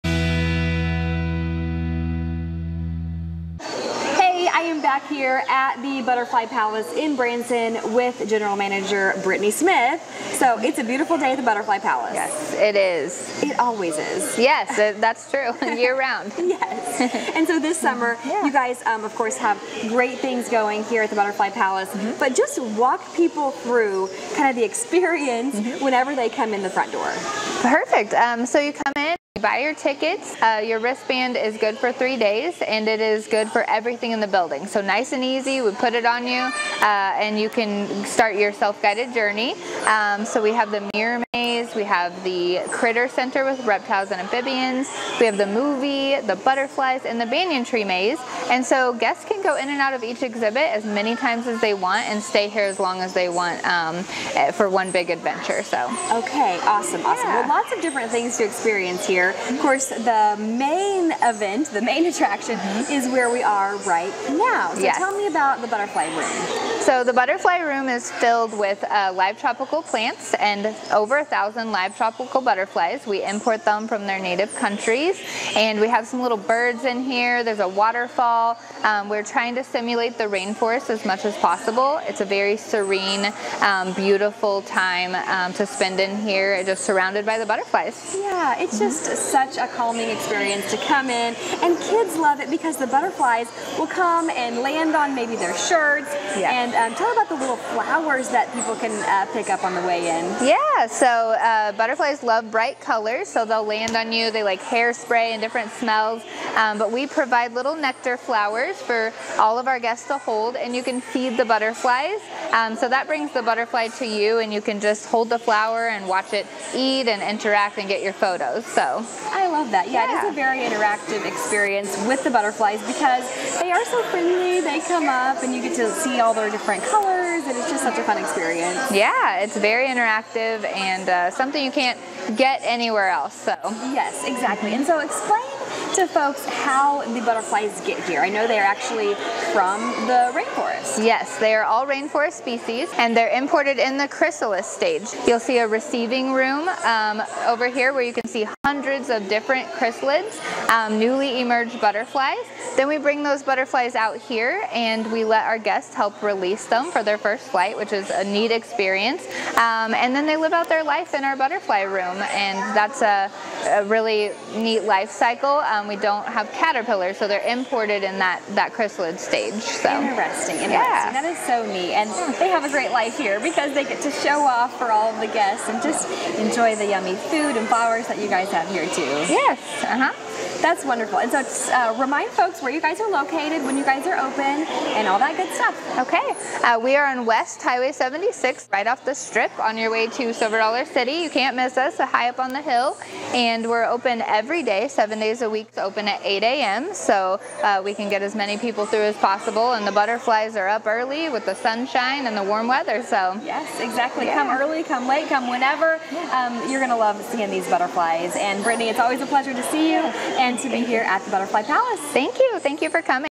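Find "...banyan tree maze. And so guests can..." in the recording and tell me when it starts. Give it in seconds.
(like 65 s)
47 s.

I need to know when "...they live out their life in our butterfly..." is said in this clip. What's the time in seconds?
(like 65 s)
160 s.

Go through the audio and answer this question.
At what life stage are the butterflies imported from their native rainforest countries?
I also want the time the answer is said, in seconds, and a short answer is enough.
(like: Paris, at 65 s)
chrysalis stage, at 144 s.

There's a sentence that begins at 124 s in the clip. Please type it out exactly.
They come up and you get to see all their different colors and it's just such a fun experience.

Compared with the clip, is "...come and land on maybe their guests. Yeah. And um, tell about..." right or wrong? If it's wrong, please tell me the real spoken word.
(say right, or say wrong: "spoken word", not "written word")
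wrong: "shirts", not "guests".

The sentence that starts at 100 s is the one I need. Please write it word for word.
Yeah, so uh, butterflies love bright colors, so they'll land on you.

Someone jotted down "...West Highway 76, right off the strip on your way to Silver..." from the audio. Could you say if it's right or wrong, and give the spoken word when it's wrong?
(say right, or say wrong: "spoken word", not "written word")
right.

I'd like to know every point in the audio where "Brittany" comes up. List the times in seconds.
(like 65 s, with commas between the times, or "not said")
9 s, 208 s.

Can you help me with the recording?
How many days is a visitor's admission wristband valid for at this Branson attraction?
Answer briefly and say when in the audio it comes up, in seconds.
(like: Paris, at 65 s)
3 days, at 31 s.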